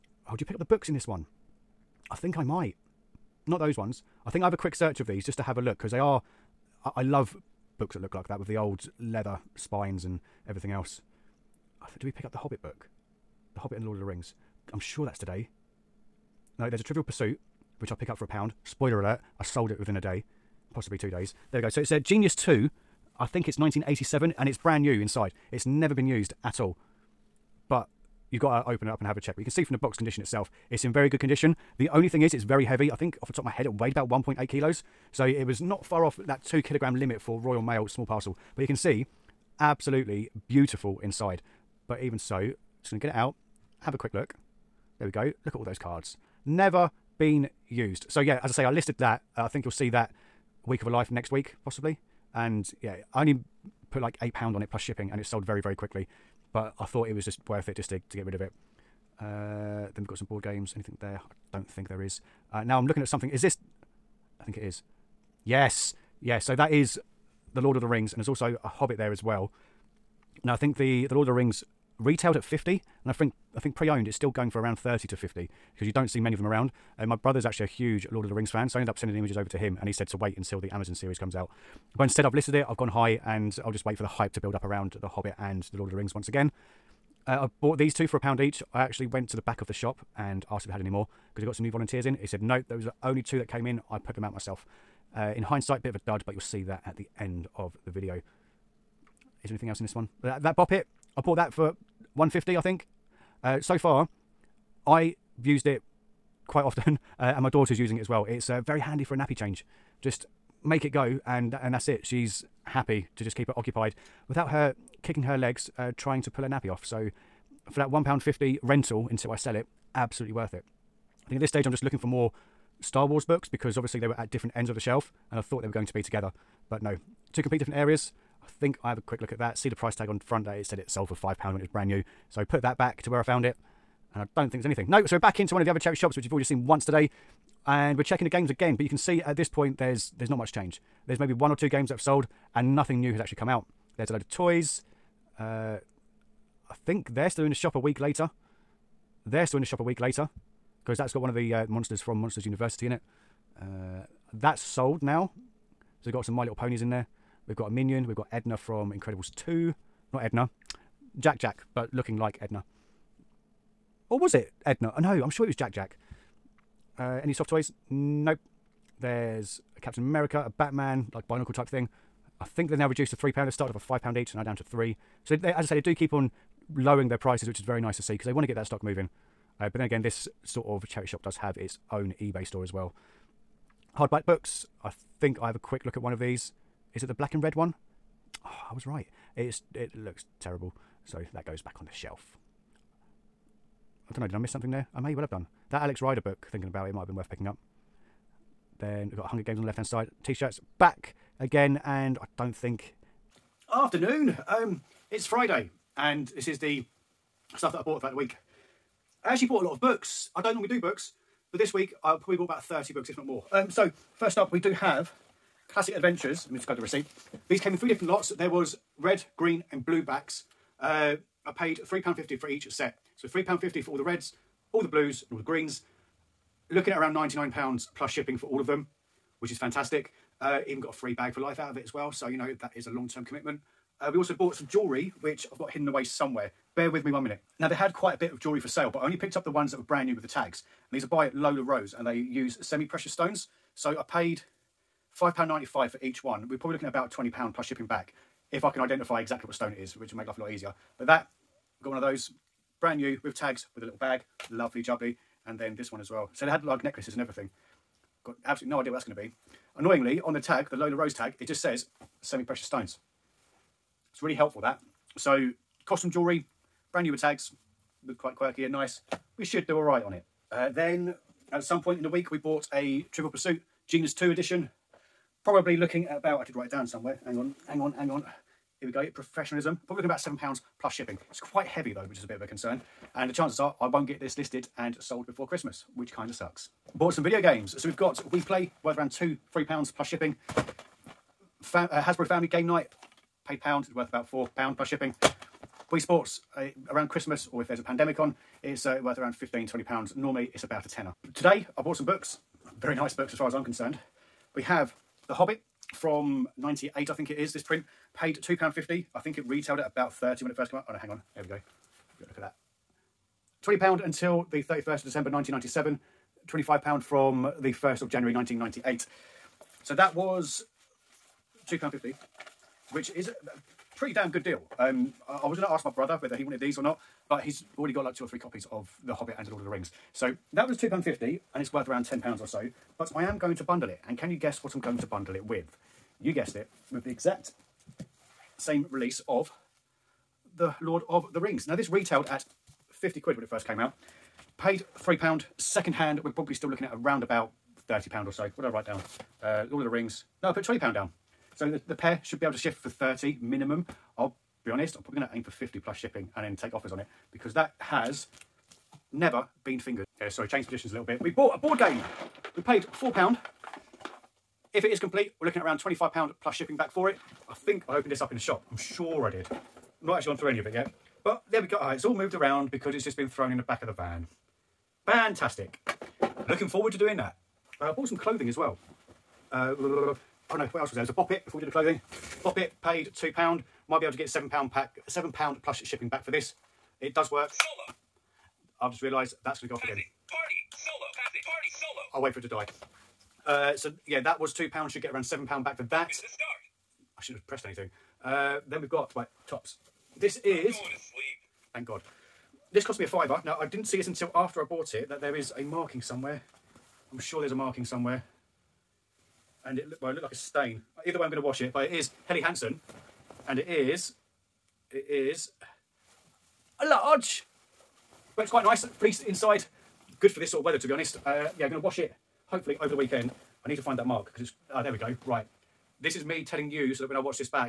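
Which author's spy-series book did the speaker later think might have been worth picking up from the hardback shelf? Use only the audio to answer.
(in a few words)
Alex Rider.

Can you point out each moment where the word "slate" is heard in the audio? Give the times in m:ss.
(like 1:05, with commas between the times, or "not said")
not said.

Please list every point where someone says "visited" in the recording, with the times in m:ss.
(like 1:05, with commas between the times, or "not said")
not said.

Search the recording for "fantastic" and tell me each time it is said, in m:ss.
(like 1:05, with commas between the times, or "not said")
3:49, 6:15.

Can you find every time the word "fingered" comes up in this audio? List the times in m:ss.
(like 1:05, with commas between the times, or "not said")
5:59.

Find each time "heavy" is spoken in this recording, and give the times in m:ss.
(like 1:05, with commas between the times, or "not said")
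0:32, 4:41.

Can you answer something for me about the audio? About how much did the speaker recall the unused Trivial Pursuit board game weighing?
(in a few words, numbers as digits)
1.8 kilos.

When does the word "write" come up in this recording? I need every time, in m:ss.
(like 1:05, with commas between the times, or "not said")
4:36, 5:48.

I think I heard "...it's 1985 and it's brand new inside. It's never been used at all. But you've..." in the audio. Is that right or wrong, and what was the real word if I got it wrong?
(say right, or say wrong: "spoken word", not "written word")
wrong: "1987", not "1985".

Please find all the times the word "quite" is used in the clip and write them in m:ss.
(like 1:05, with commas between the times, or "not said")
1:46, 3:57, 4:28, 4:41, 6:58.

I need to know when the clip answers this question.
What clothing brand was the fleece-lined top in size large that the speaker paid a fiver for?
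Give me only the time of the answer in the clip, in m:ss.
6:52.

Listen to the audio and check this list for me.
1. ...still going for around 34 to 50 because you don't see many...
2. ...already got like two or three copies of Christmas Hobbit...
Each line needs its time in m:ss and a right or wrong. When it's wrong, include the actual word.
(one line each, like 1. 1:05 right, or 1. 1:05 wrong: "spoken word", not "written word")
1. 1:14 wrong: "30", not "34"
2. 5:27 wrong: "The", not "Christmas".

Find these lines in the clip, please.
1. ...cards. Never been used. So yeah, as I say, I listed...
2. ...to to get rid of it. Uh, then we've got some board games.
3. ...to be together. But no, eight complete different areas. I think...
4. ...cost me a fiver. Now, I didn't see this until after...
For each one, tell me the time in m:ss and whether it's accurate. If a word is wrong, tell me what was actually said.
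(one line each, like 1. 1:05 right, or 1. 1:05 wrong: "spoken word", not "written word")
1. 0:45 right
2. 0:57 right
3. 2:05 wrong: "two", not "eight"
4. 6:42 right.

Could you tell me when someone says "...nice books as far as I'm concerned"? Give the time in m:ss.
5:02.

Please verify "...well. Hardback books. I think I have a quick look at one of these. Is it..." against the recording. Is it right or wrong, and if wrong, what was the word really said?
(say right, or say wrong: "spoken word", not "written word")
right.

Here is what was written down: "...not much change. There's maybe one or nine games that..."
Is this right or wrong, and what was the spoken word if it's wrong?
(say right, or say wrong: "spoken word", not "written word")
wrong: "two", not "nine".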